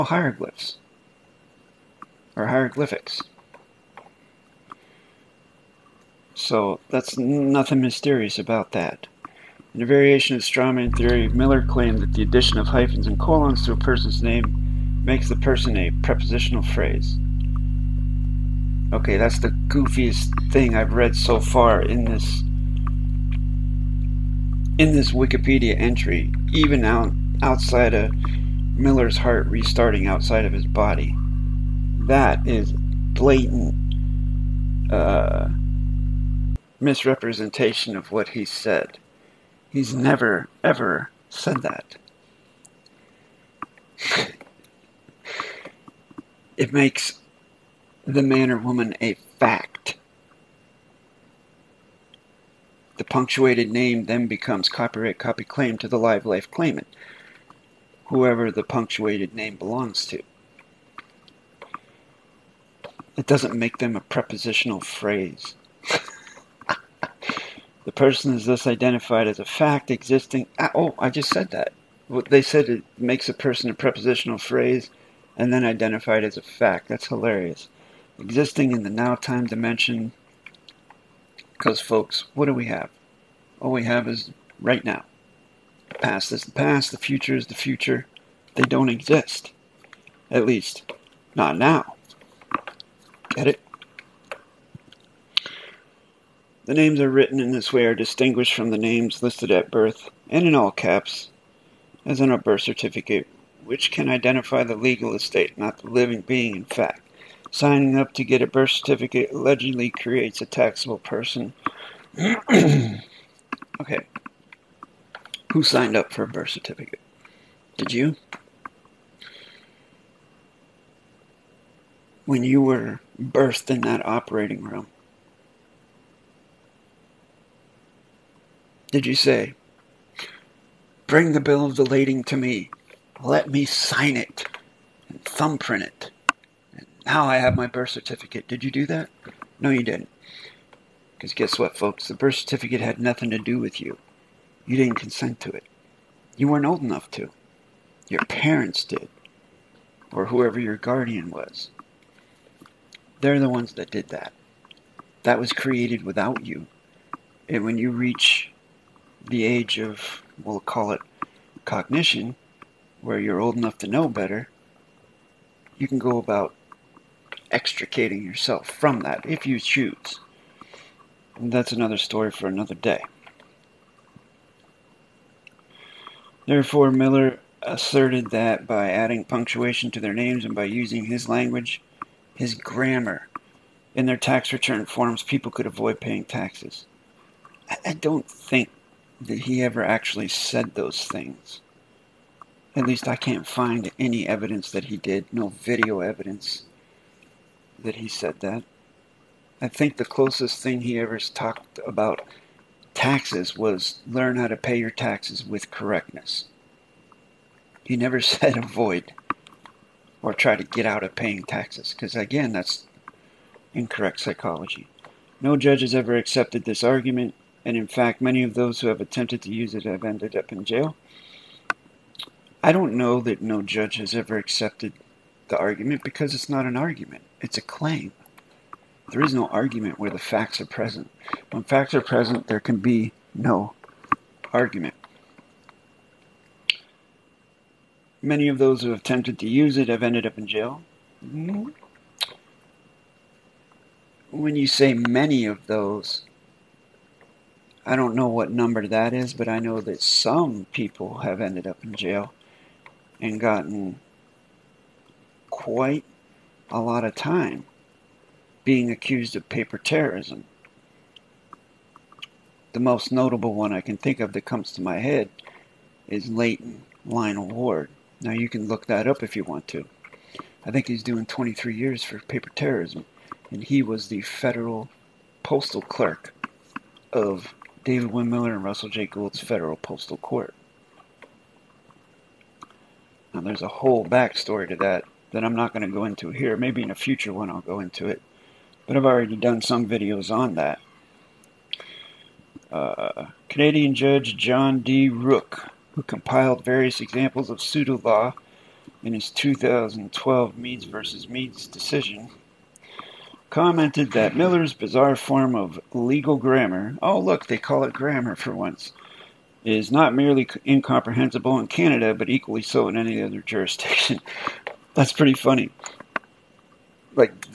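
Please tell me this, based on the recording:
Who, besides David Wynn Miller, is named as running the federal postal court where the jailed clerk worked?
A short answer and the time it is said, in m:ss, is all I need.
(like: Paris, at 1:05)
Russell J. Gould, at 4:38.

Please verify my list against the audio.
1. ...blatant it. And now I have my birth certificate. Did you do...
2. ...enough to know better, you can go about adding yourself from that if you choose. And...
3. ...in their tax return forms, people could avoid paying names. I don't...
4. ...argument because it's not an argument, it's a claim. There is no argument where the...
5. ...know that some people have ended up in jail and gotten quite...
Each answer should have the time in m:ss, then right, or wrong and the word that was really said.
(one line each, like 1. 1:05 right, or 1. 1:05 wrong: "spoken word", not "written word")
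1. 2:15 wrong: "thumbprint", not "blatant"
2. 2:43 wrong: "extricating", not "adding"
3. 3:03 wrong: "taxes", not "names"
4. 3:45 right
5. 4:09 right.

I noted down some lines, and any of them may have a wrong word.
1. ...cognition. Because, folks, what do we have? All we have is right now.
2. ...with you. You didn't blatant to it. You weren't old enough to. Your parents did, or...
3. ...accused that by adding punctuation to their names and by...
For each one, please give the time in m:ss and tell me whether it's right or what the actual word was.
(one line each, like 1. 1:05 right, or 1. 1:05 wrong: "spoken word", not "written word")
1. 1:19 wrong: "dimension", not "cognition"
2. 2:23 wrong: "consent", not "blatant"
3. 2:57 wrong: "asserted", not "accused".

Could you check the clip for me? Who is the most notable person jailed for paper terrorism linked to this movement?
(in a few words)
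Leighton Lionel Ward.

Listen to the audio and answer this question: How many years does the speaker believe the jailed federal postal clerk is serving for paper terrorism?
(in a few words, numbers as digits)
23.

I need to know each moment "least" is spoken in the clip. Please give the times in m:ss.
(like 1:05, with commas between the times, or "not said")
1:30, 3:12.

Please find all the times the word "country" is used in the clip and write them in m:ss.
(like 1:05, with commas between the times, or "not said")
not said.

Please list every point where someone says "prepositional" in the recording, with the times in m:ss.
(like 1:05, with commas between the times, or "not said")
0:16, 1:03, 1:13.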